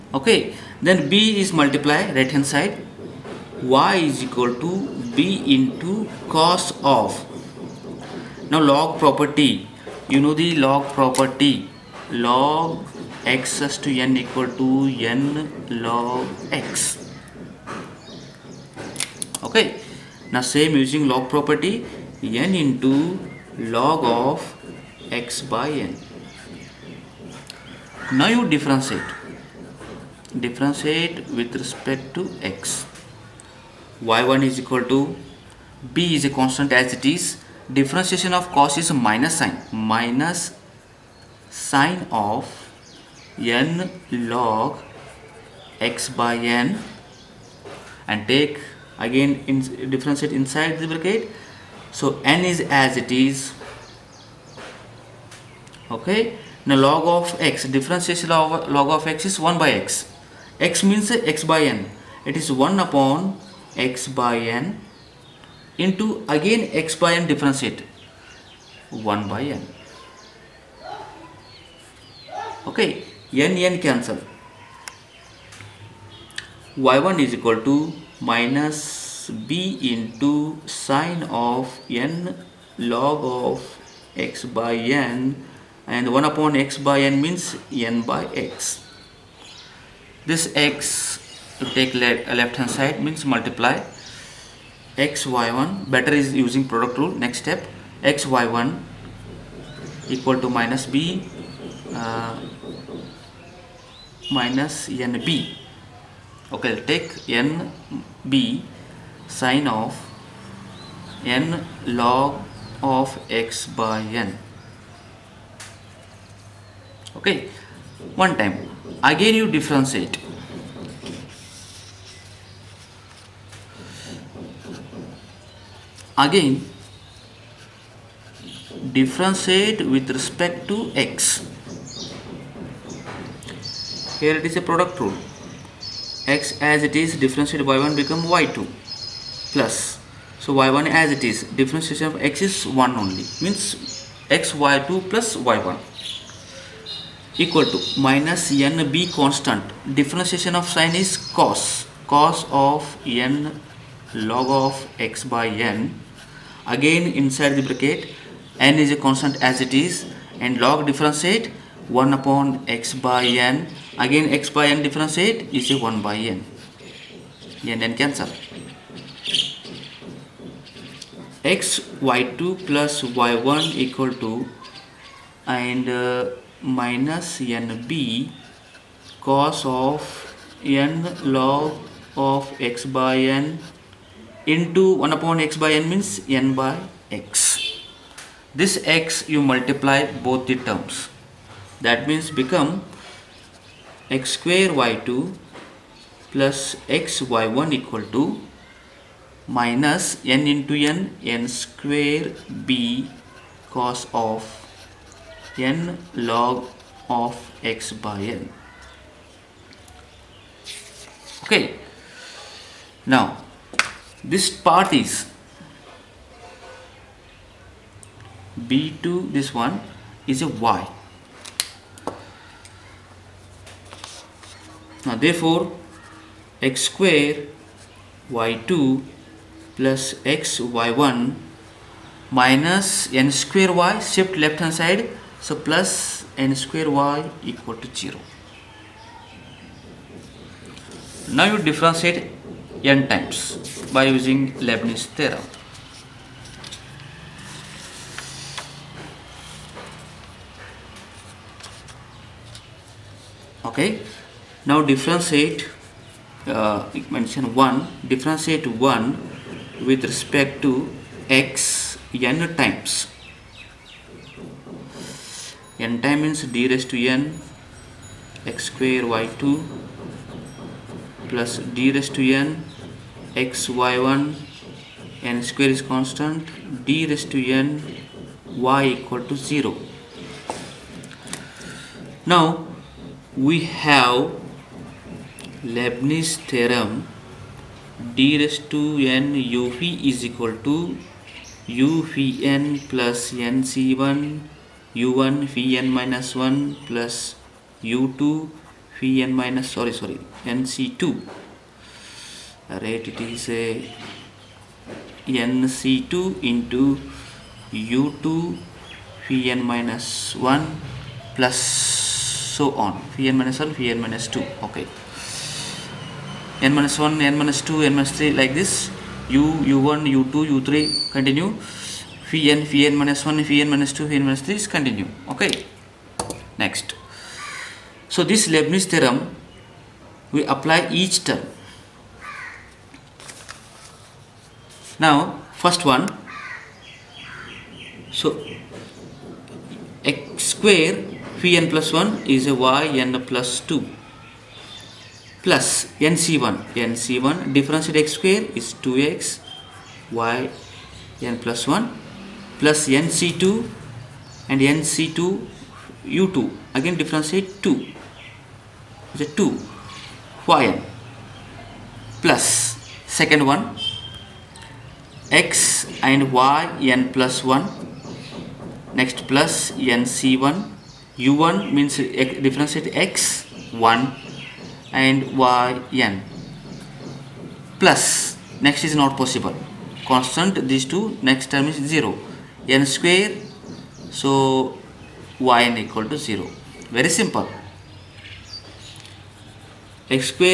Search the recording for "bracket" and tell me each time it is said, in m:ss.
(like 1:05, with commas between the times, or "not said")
0:50, 2:37.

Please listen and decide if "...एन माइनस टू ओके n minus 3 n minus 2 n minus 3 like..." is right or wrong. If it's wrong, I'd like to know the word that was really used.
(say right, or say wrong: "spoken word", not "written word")
wrong: "1", not "3".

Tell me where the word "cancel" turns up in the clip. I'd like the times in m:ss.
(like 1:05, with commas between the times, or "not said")
1:13, 2:48.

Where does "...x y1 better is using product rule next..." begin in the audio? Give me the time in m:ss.
1:34.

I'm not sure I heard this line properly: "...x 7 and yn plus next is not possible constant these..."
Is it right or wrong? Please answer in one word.
wrong.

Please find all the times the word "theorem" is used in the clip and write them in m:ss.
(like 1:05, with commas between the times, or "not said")
4:05, 4:46, 5:28.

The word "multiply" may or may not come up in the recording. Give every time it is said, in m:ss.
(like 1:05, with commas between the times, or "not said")
0:01, 1:33, 3:09.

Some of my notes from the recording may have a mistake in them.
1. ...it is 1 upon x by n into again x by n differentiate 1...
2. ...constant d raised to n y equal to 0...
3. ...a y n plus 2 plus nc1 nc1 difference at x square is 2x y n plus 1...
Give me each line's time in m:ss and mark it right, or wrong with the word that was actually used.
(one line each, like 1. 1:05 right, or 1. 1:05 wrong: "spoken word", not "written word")
1. 1:02 right
2. 4:35 right
3. 5:42 right.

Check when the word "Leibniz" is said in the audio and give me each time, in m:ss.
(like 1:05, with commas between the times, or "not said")
4:04, 4:45, 5:28.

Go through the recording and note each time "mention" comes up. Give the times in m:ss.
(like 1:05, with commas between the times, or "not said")
4:17.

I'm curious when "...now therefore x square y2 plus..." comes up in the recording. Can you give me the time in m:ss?
3:45.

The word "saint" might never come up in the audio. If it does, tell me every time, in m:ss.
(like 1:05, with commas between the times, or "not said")
not said.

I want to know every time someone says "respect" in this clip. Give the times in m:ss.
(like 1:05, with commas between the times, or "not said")
0:31, 2:10, 4:20.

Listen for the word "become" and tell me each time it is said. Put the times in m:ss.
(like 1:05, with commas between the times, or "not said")
2:17, 3:12.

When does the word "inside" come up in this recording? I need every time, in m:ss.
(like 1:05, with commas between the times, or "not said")
0:50, 2:37.